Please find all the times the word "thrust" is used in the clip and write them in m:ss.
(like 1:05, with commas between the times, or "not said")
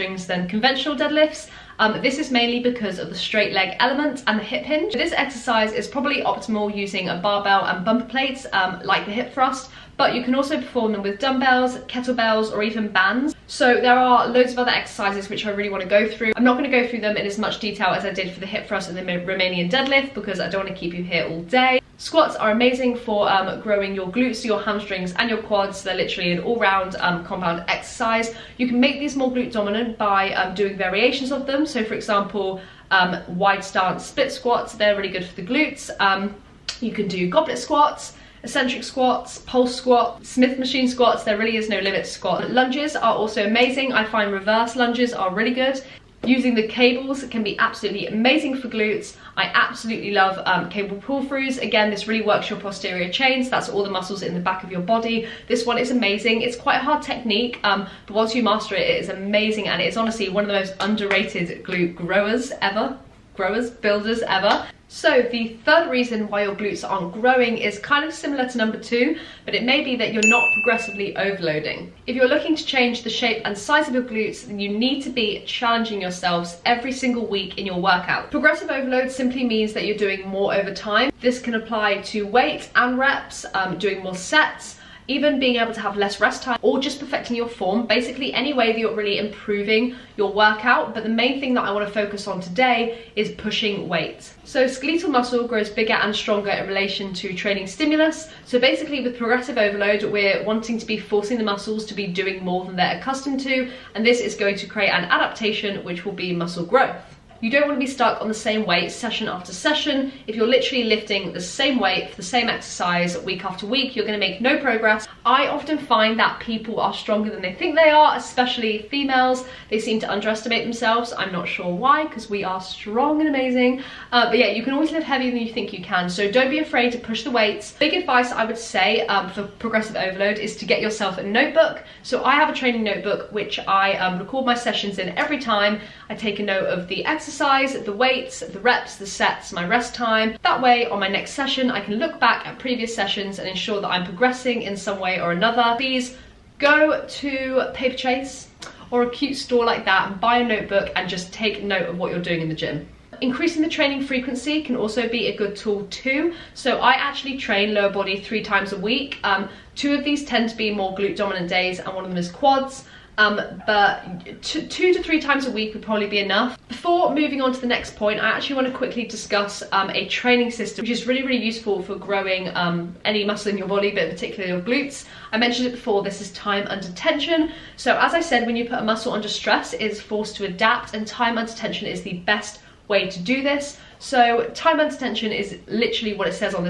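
0:09, 0:18.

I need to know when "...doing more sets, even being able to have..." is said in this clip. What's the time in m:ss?
1:23.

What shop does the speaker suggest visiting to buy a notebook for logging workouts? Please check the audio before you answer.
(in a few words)
Paperchase.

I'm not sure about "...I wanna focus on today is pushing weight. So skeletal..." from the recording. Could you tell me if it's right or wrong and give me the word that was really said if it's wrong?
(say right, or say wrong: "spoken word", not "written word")
right.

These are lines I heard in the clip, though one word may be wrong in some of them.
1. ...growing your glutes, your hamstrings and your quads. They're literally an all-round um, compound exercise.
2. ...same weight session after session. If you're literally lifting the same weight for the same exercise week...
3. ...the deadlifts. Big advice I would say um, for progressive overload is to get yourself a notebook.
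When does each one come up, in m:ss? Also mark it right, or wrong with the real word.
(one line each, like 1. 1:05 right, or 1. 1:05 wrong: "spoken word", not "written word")
1. 0:23 right
2. 1:48 right
3. 2:07 wrong: "weights", not "deadlifts".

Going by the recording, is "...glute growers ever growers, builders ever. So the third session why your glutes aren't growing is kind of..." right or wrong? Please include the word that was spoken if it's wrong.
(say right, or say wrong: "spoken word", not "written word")
wrong: "reason", not "session".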